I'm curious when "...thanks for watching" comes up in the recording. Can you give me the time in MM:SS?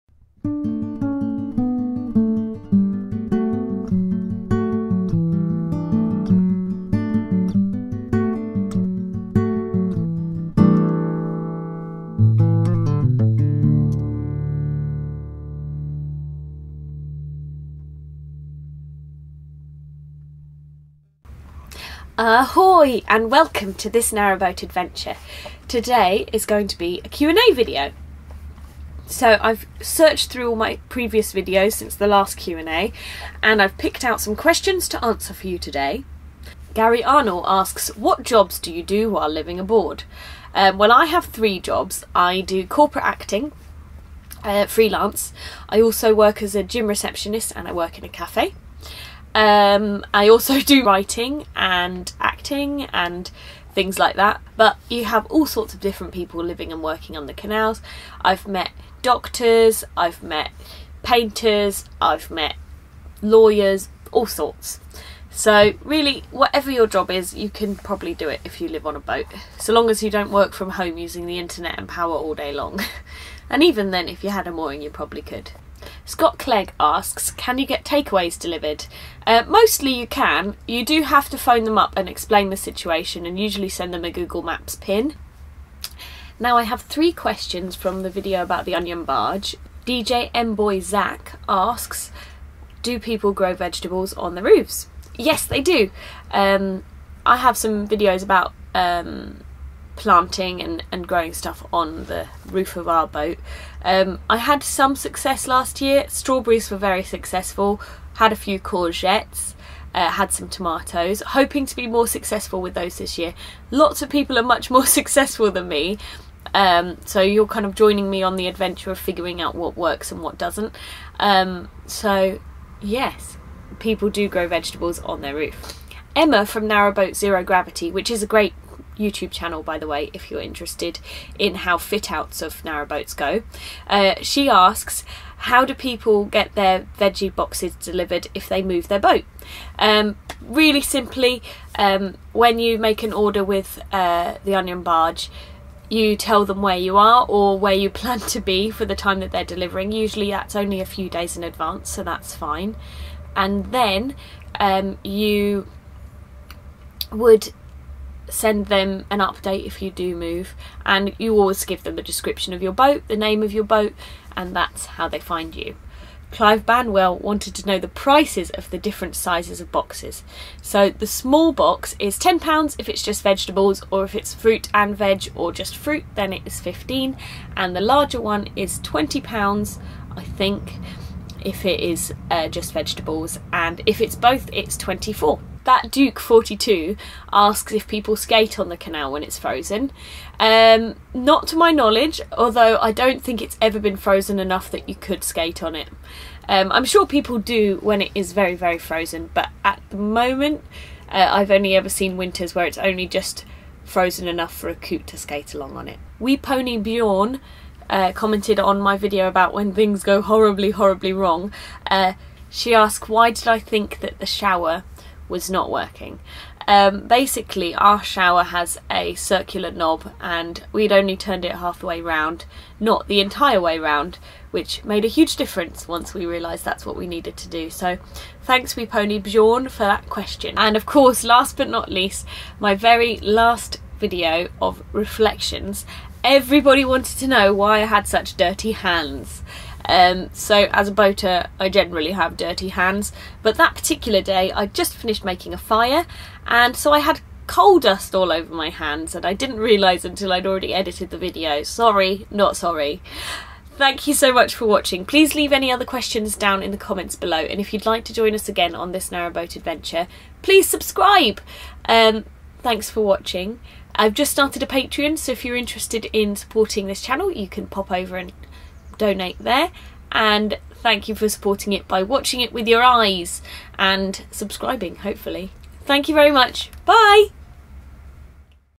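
04:22.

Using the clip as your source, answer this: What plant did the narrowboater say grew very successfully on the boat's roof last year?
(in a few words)
Strawberries.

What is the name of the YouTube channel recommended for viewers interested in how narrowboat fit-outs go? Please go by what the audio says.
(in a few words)
Narrowboat Zero Gravity.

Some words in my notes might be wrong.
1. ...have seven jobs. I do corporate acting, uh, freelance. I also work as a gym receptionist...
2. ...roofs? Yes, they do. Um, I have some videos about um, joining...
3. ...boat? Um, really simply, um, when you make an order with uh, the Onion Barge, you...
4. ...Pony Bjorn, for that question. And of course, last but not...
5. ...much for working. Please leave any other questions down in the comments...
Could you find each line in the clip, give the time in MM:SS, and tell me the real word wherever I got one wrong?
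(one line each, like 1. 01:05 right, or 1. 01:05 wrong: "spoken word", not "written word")
1. 00:41 wrong: "three", not "seven"
2. 01:34 wrong: "planting", not "joining"
3. 02:18 right
4. 03:48 right
5. 04:14 wrong: "watching", not "working".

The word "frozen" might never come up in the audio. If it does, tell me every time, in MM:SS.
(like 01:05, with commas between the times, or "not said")
03:09, 03:13, 03:18, 03:23.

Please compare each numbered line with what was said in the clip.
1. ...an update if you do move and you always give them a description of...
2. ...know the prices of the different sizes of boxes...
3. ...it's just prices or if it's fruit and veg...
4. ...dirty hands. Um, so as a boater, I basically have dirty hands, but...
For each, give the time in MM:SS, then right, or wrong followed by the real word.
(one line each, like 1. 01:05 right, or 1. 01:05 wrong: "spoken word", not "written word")
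1. 02:39 right
2. 02:47 right
3. 02:52 wrong: "vegetables", not "prices"
4. 03:58 wrong: "generally", not "basically".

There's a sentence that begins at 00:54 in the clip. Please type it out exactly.
But you have all sorts of different people living and working on the canals.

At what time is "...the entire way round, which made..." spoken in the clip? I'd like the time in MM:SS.
03:43.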